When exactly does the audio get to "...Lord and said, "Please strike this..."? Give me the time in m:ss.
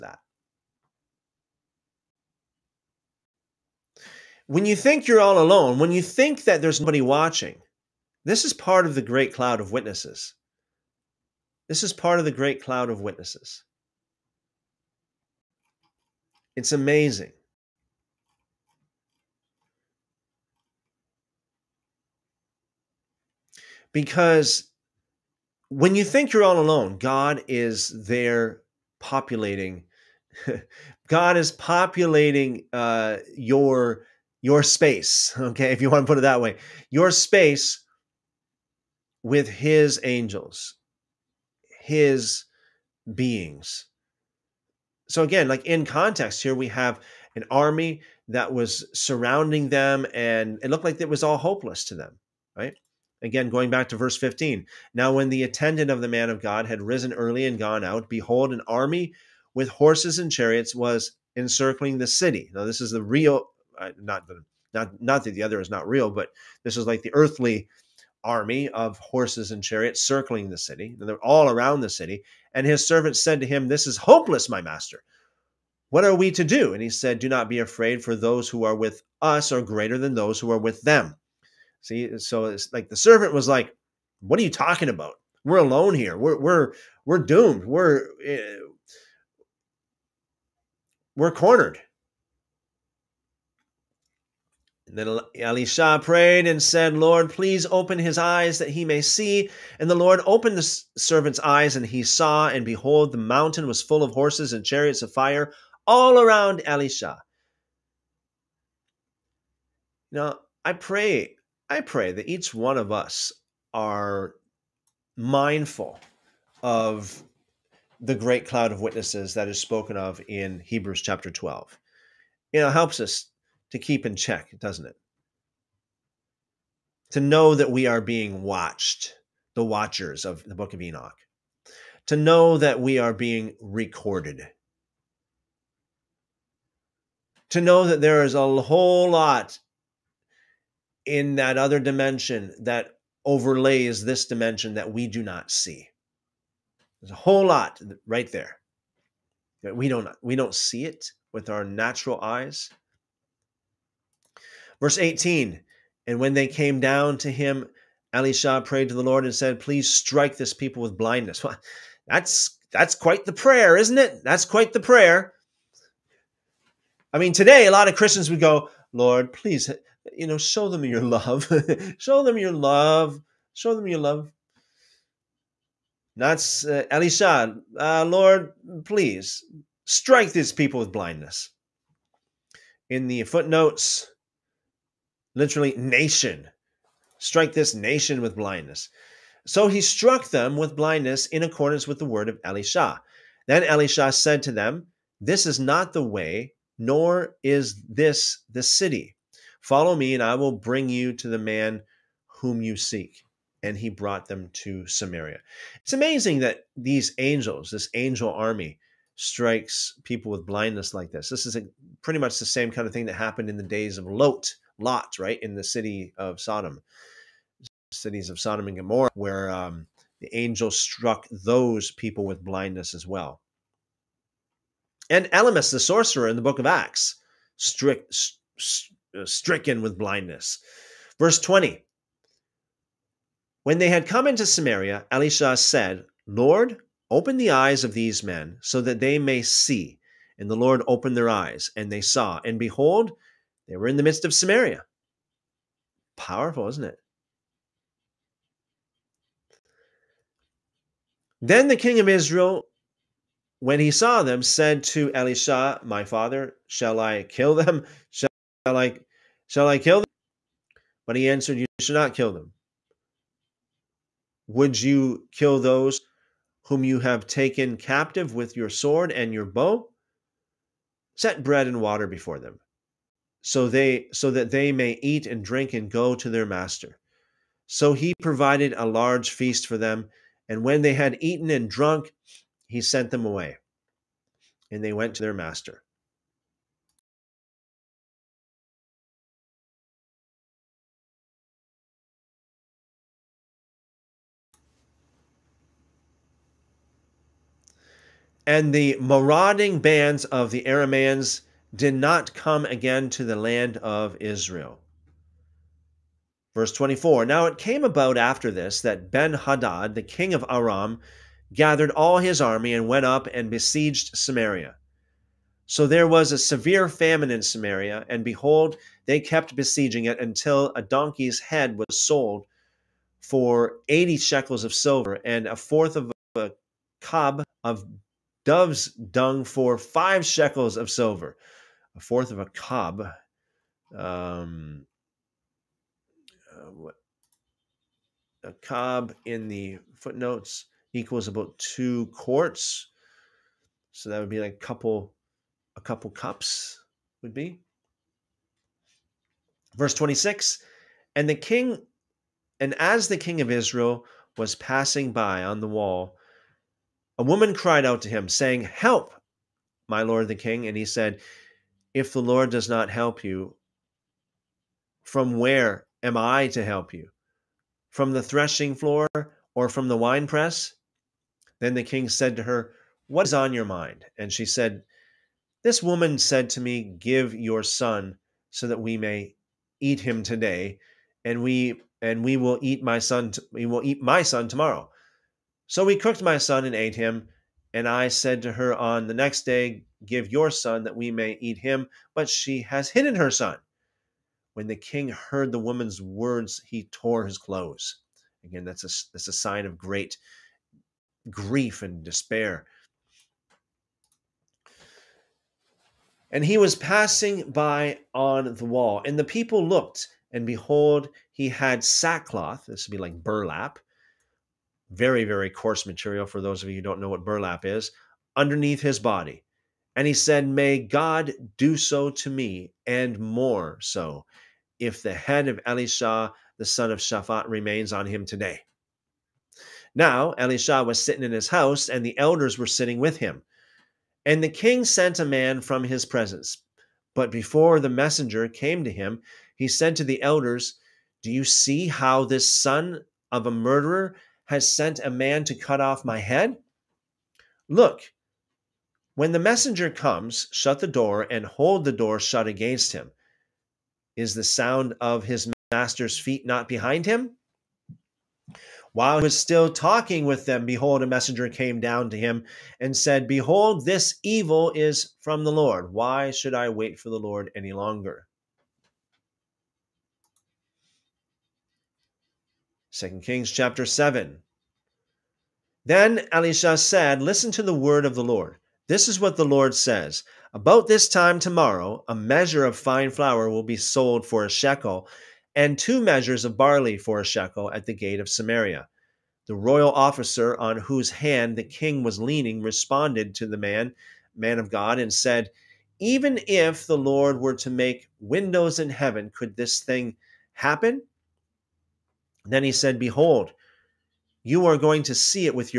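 2:39.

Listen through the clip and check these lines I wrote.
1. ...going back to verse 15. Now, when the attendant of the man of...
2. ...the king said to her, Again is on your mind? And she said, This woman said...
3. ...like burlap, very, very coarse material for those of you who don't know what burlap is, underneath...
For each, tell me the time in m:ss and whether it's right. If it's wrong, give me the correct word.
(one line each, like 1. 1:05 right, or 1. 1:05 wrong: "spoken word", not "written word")
1. 0:53 right
2. 6:11 wrong: "What", not "Again"
3. 6:53 right.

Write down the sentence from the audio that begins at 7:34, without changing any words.
Is the sound of his master's feet not behind him?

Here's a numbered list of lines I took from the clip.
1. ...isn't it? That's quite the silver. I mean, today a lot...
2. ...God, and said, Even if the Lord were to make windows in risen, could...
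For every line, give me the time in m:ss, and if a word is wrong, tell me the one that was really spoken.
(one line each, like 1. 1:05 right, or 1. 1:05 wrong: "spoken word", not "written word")
1. 2:43 wrong: "prayer", not "silver"
2. 8:14 wrong: "heaven", not "risen".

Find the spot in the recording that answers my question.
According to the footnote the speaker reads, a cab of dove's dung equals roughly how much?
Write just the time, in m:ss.
5:41.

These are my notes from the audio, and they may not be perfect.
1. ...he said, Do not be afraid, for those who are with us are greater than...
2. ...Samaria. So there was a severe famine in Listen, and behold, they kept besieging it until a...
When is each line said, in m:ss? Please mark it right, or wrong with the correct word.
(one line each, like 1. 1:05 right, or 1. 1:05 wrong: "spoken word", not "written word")
1. 1:16 right
2. 5:14 wrong: "Samaria", not "Listen".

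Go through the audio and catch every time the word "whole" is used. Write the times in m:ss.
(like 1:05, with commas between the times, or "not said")
2:18, 2:27.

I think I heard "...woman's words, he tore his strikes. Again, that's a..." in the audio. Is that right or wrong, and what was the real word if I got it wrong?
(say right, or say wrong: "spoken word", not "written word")
wrong: "clothes", not "strikes".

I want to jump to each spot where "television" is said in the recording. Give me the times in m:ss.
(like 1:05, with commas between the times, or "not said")
not said.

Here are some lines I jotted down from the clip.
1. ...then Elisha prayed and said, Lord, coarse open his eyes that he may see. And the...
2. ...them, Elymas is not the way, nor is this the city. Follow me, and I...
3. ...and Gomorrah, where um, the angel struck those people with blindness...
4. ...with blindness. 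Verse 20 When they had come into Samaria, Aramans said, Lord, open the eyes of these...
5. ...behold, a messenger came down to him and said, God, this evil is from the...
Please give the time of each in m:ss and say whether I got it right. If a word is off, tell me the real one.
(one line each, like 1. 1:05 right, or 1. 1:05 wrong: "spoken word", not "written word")
1. 1:34 wrong: "please", not "coarse"
2. 3:14 wrong: "This", not "Elymas"
3. 3:38 right
4. 3:49 wrong: "Elisha", not "Aramans"
5. 7:40 wrong: "Behold", not "God".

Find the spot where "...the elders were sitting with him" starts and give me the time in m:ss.
7:12.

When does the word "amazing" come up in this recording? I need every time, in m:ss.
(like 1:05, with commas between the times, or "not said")
0:16, 3:25.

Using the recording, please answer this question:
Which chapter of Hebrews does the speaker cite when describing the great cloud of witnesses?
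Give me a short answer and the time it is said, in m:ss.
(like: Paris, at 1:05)
Chapter 12, at 2:00.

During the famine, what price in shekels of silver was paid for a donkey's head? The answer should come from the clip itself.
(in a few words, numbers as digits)
80 shekels.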